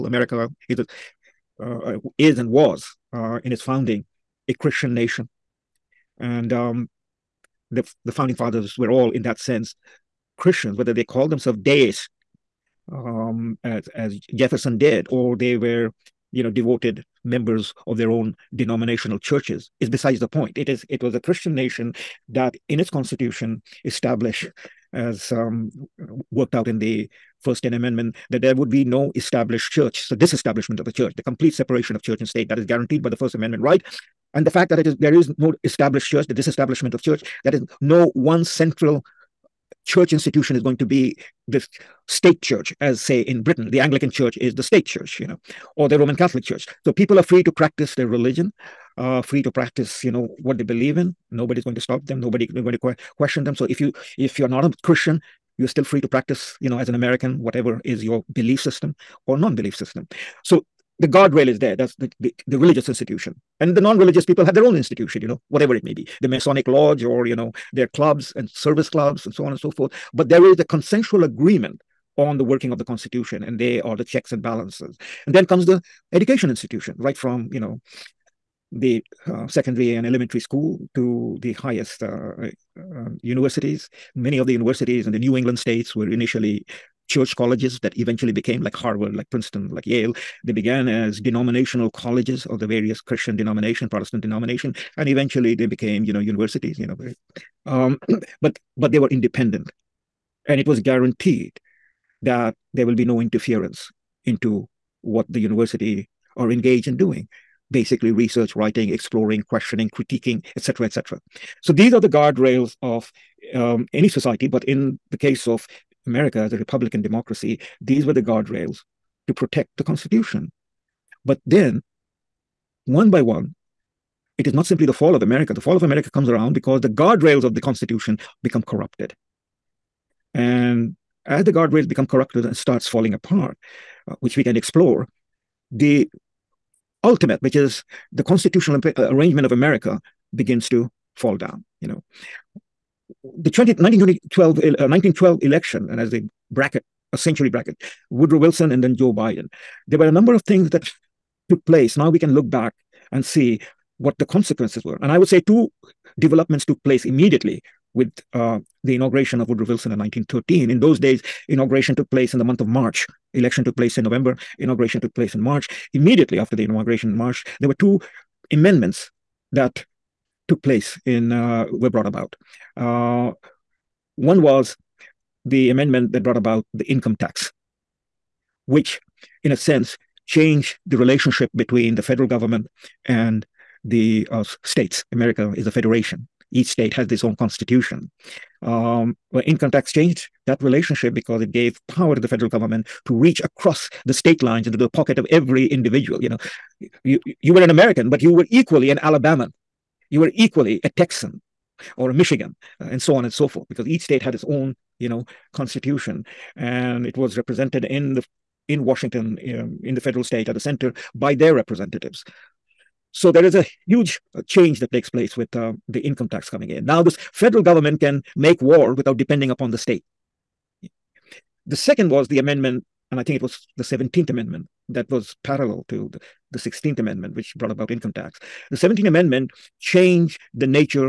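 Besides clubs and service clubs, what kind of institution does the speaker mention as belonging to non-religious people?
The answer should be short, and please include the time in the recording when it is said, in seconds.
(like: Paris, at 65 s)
Masonic lodge, at 66 s.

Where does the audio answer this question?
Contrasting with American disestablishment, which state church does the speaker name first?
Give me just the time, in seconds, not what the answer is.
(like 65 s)
43 s.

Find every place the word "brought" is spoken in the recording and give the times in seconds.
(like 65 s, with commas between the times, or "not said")
171 s, 176 s, 227 s.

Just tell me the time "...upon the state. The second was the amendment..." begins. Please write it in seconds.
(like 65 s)
219 s.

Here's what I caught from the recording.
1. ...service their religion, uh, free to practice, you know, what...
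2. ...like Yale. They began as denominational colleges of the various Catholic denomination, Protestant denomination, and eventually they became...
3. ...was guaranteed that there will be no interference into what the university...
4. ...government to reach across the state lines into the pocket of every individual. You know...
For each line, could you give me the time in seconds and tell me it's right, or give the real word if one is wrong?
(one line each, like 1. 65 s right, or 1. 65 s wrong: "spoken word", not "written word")
1. 47 s wrong: "practice", not "service"
2. 89 s wrong: "Christian", not "Catholic"
3. 100 s right
4. 192 s right.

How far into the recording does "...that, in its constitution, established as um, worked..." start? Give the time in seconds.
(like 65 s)
22 s.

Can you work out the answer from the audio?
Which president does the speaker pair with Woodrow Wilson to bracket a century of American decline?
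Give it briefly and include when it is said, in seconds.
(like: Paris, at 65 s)
Joe Biden, at 148 s.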